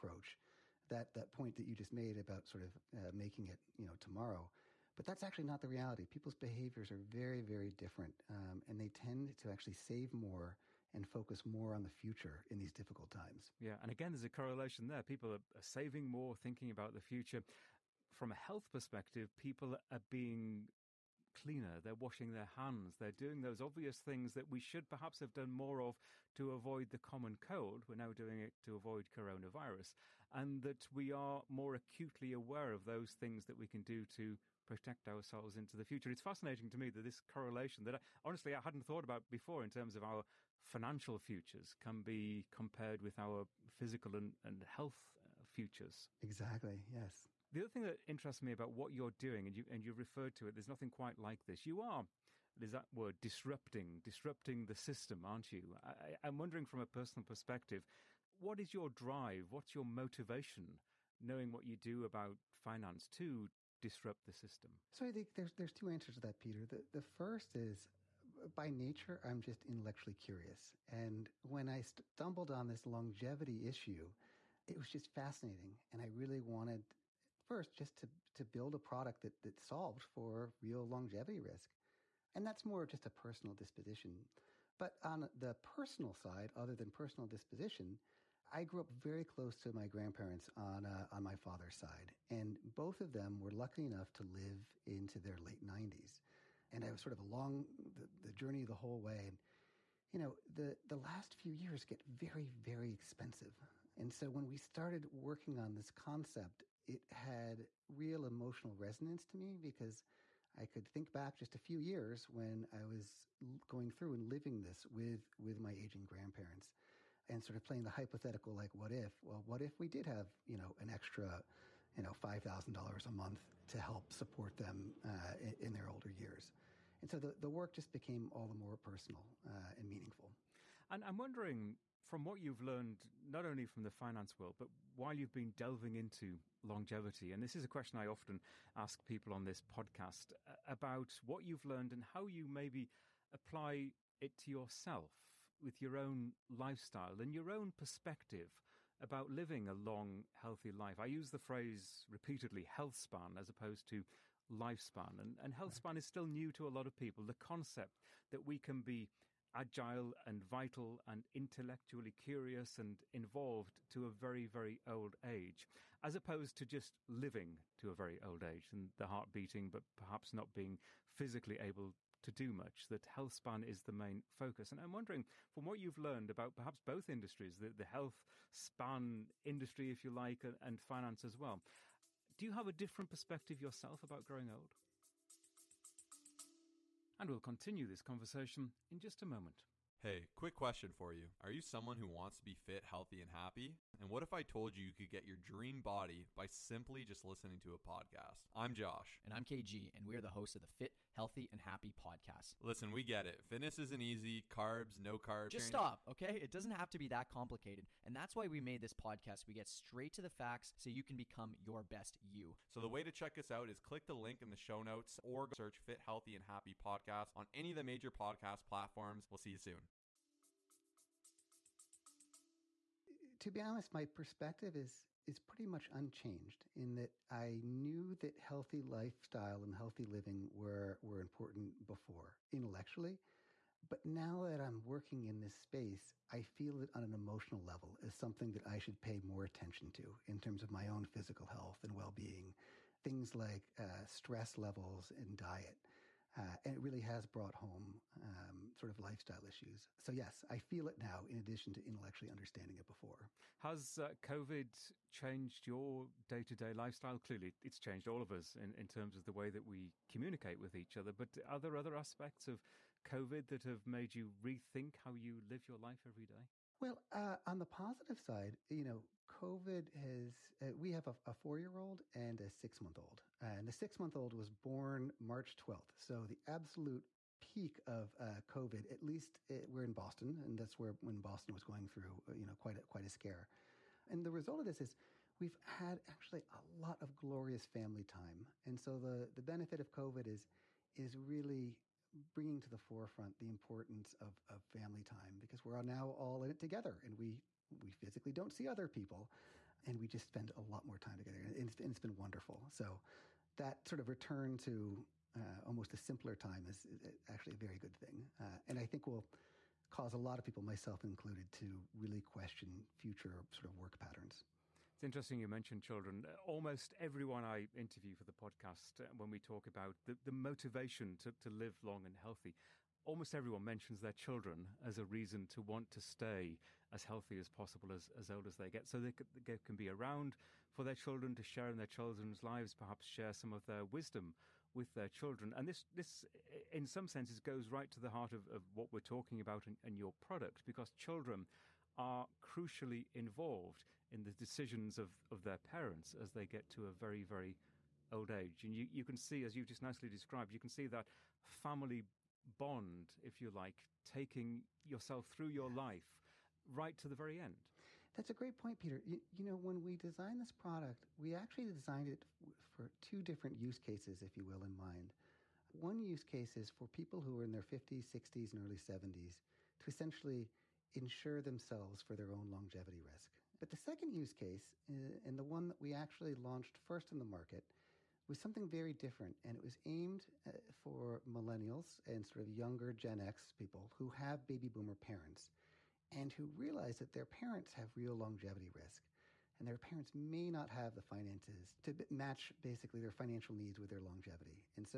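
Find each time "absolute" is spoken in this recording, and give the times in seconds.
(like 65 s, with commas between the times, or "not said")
276 s.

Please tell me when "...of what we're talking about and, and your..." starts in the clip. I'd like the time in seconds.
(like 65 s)
338 s.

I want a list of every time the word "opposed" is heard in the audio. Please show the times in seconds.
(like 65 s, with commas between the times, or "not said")
153 s, 166 s.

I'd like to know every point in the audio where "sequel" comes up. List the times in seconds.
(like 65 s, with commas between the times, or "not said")
not said.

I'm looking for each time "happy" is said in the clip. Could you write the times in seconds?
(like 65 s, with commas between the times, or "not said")
193 s, 201 s, 216 s.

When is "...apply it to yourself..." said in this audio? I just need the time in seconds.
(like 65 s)
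143 s.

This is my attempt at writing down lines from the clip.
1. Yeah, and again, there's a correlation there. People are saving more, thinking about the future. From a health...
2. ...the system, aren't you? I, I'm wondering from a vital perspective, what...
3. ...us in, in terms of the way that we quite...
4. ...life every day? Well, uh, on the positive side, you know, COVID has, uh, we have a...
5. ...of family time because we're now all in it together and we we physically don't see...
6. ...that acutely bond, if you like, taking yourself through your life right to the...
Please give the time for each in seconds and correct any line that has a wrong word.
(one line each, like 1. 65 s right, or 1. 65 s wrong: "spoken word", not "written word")
1. 13 s right
2. 54 s wrong: "personal", not "vital"
3. 258 s wrong: "communicate", not "quite"
4. 265 s right
5. 294 s right
6. 350 s wrong: "family", not "acutely".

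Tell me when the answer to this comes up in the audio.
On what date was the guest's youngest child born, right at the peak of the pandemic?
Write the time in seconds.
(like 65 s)
275 s.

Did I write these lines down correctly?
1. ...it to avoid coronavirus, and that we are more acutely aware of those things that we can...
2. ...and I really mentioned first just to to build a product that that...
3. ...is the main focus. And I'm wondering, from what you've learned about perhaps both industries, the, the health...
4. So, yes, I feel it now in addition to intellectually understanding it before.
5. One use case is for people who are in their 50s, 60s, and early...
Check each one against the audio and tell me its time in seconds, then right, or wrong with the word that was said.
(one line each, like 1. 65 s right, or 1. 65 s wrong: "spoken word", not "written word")
1. 28 s right
2. 75 s wrong: "wanted", not "mentioned"
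3. 173 s right
4. 249 s right
5. 365 s right.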